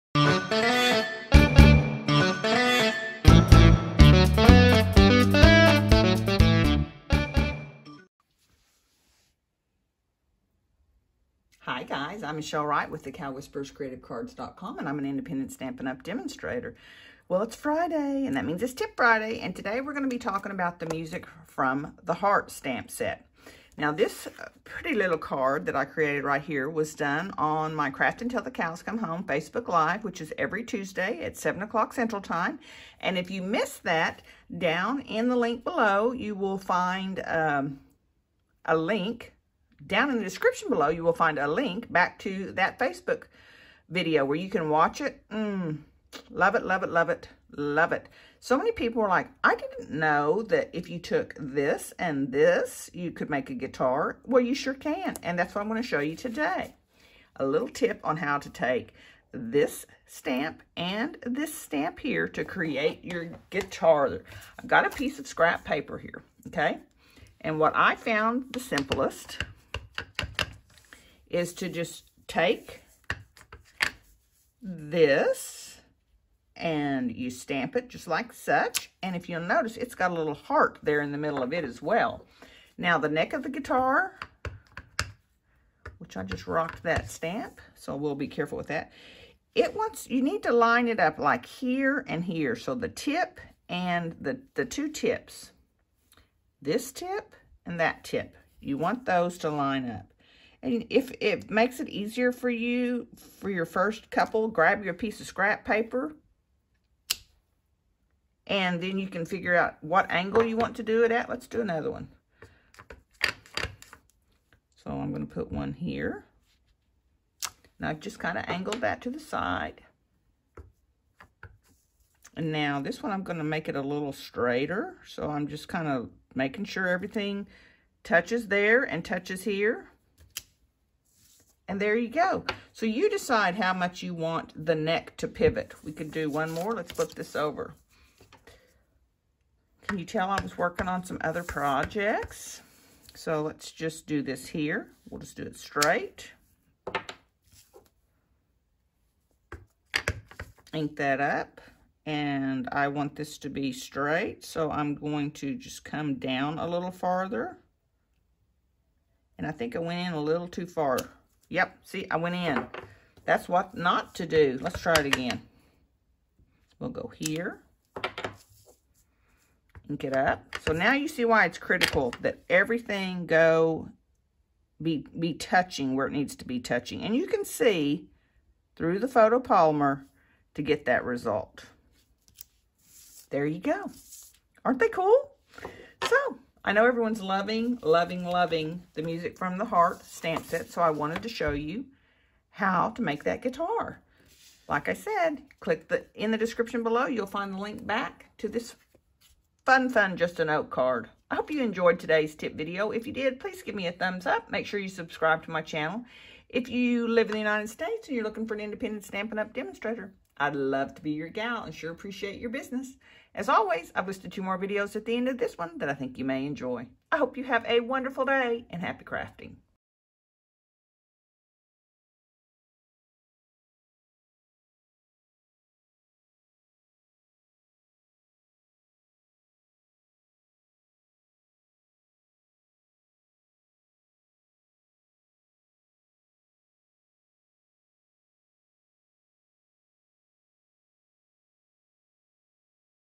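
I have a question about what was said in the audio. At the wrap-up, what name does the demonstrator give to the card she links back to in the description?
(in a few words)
Just a Note.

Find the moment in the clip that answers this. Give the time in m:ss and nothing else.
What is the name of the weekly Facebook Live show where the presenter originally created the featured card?
0:27.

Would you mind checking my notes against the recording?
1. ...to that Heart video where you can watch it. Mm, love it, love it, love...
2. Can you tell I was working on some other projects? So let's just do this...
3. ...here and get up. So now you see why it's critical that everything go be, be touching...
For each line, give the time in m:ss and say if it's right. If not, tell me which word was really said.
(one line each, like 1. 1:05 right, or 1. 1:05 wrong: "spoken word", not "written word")
1. 0:42 wrong: "Facebook", not "Heart"
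2. 2:19 right
3. 2:47 right.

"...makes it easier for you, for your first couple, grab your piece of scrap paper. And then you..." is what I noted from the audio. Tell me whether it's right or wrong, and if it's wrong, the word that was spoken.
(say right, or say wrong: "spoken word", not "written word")
right.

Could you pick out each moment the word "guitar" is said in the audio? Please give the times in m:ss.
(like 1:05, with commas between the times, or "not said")
0:53, 1:03, 1:23, 3:13.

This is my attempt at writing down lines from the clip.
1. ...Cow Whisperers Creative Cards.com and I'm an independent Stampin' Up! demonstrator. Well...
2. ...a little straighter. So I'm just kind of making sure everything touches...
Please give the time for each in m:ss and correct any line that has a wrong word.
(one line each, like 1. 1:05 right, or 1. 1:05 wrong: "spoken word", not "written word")
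1. 0:13 right
2. 2:03 right.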